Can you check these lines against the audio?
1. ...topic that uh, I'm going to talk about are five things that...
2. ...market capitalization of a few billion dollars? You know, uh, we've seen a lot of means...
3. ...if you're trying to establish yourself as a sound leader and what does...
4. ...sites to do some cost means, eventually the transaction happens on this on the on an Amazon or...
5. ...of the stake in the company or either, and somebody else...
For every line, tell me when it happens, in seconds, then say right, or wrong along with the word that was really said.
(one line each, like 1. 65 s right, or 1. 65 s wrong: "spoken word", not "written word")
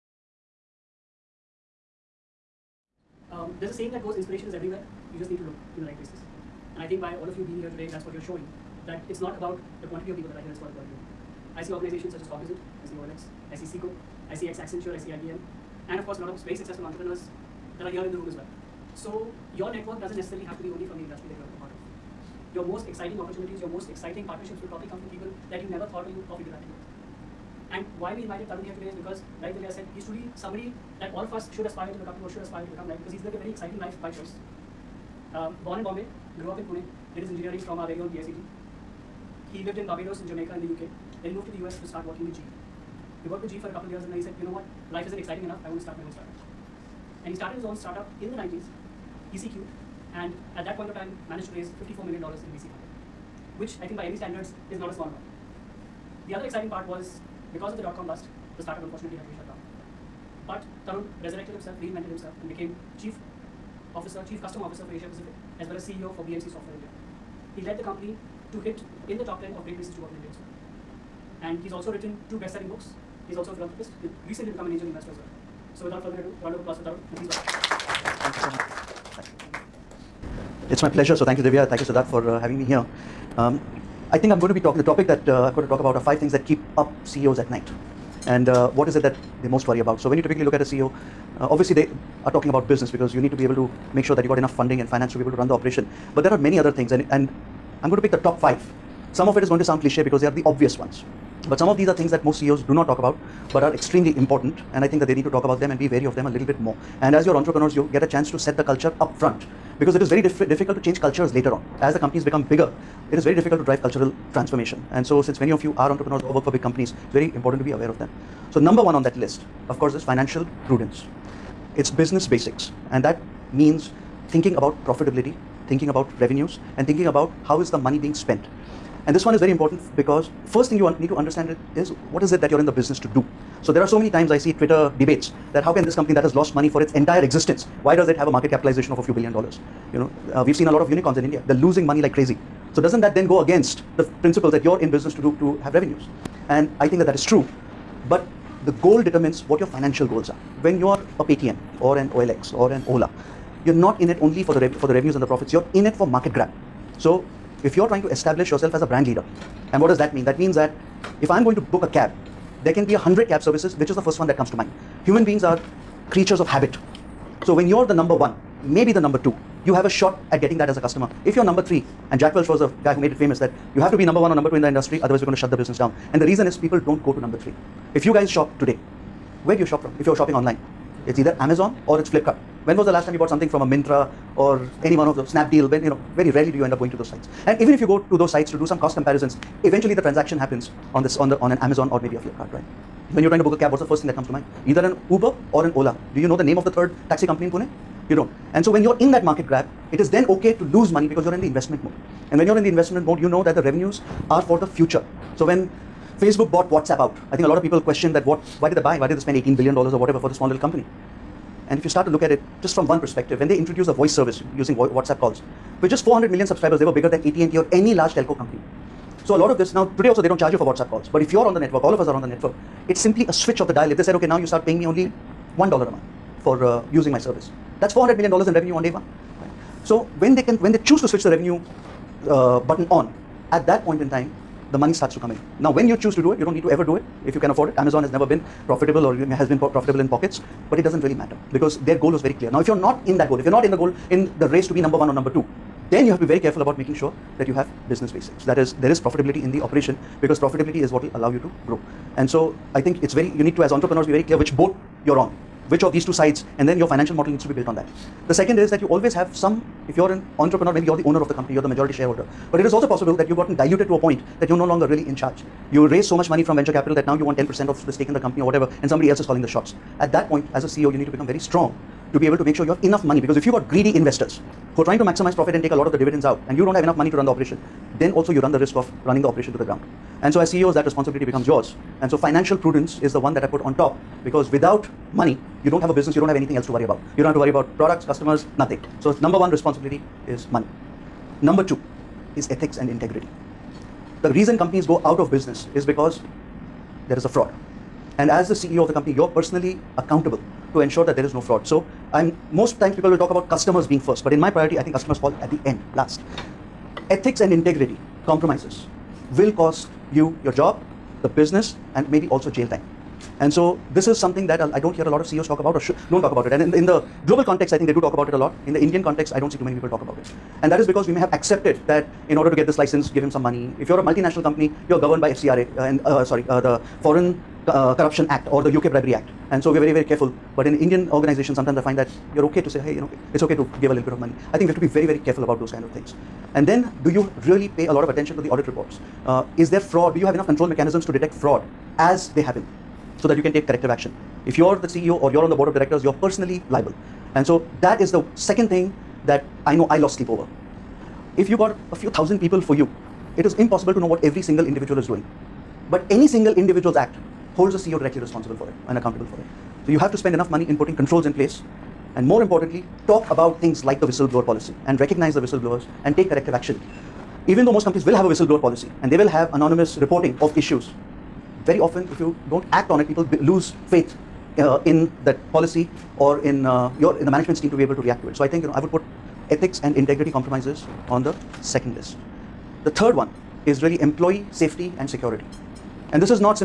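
1. 84 s right
2. 138 s wrong: "unicorns", not "means"
3. 157 s wrong: "brand", not "sound"
4. 188 s wrong: "comparisons", not "means"
5. 267 s wrong: "whatever", not "either".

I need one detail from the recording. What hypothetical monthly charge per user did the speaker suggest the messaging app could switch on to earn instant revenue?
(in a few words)
1 dollar.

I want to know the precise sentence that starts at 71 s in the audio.
And he's also written two best-selling books.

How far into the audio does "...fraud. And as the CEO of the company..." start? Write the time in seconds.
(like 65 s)
297 s.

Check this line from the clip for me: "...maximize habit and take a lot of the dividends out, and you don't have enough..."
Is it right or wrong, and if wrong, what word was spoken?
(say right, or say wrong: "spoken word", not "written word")
wrong: "profit", not "habit".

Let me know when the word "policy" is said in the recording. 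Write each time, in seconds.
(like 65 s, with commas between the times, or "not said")
364 s, 368 s, 375 s.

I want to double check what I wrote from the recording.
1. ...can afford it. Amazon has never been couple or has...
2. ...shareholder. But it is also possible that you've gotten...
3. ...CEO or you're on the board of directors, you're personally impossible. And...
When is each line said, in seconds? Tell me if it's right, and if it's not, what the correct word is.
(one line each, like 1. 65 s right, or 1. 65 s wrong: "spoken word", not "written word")
1. 237 s wrong: "profitable", not "couple"
2. 261 s right
3. 344 s wrong: "liable", not "impossible".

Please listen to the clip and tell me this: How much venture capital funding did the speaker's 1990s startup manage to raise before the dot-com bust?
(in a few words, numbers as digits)
$54 million.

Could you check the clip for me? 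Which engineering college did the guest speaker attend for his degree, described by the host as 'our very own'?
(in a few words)
PICT.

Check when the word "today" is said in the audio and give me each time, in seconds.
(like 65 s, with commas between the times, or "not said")
7 s, 28 s, 178 s, 219 s.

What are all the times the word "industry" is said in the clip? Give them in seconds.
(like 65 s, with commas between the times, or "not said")
21 s, 174 s.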